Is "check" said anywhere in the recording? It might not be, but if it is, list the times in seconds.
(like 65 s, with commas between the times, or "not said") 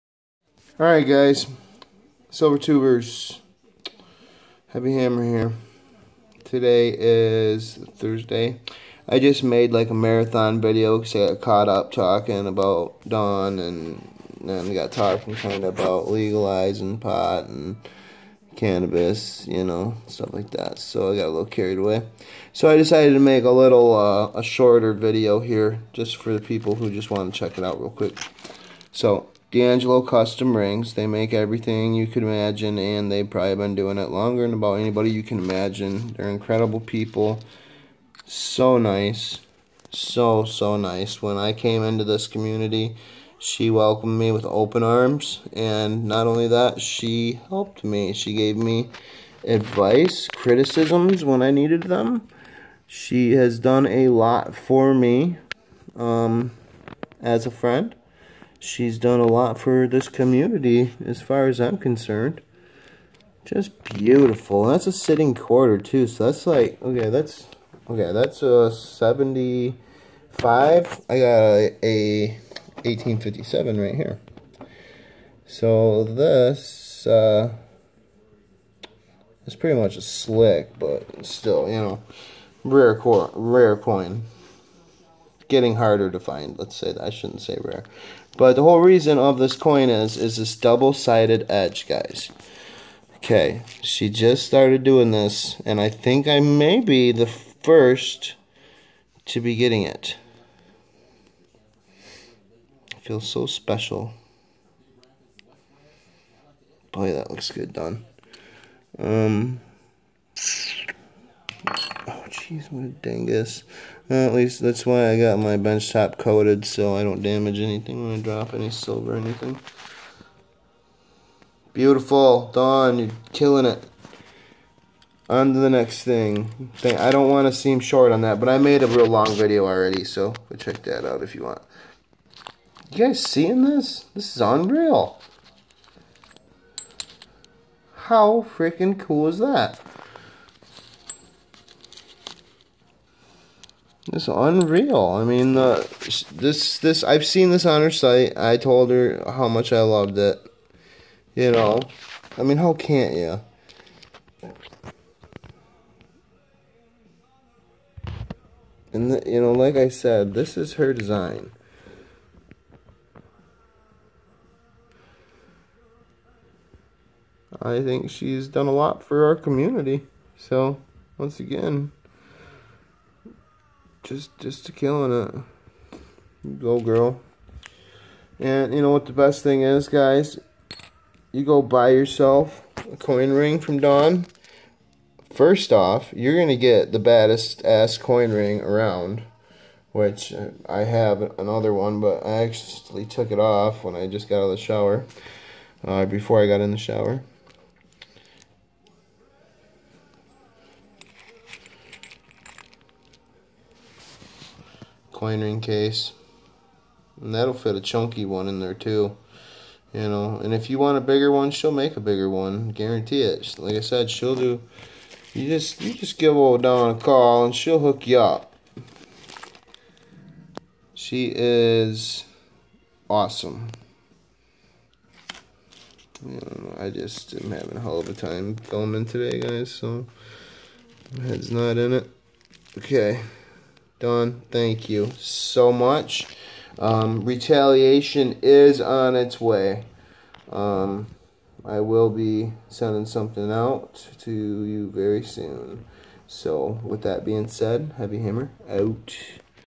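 27 s, 130 s.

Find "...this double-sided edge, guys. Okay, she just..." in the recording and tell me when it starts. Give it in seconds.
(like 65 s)
90 s.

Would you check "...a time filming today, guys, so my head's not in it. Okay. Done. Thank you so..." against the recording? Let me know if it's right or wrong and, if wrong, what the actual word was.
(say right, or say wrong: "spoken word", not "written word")
right.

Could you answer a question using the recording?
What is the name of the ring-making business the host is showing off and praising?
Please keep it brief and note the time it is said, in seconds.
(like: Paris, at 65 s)
D'Angelo Custom Rings, at 29 s.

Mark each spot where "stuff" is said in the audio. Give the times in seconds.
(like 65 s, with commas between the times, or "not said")
20 s.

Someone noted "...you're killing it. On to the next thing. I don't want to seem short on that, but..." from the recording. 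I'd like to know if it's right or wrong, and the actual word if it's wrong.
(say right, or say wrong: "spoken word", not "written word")
right.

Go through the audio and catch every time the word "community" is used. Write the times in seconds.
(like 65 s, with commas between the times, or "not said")
42 s, 60 s, 169 s.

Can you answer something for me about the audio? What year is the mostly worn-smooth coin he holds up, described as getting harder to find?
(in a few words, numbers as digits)
1857.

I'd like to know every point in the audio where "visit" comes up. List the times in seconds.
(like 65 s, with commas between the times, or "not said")
not said.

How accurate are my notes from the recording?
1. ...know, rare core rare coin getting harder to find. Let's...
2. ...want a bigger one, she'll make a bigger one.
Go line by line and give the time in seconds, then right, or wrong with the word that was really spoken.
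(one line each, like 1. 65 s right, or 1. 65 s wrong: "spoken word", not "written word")
1. 81 s right
2. 210 s right.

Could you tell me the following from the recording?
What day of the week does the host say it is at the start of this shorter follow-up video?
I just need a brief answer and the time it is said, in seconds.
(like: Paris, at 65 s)
Thursday, at 7 s.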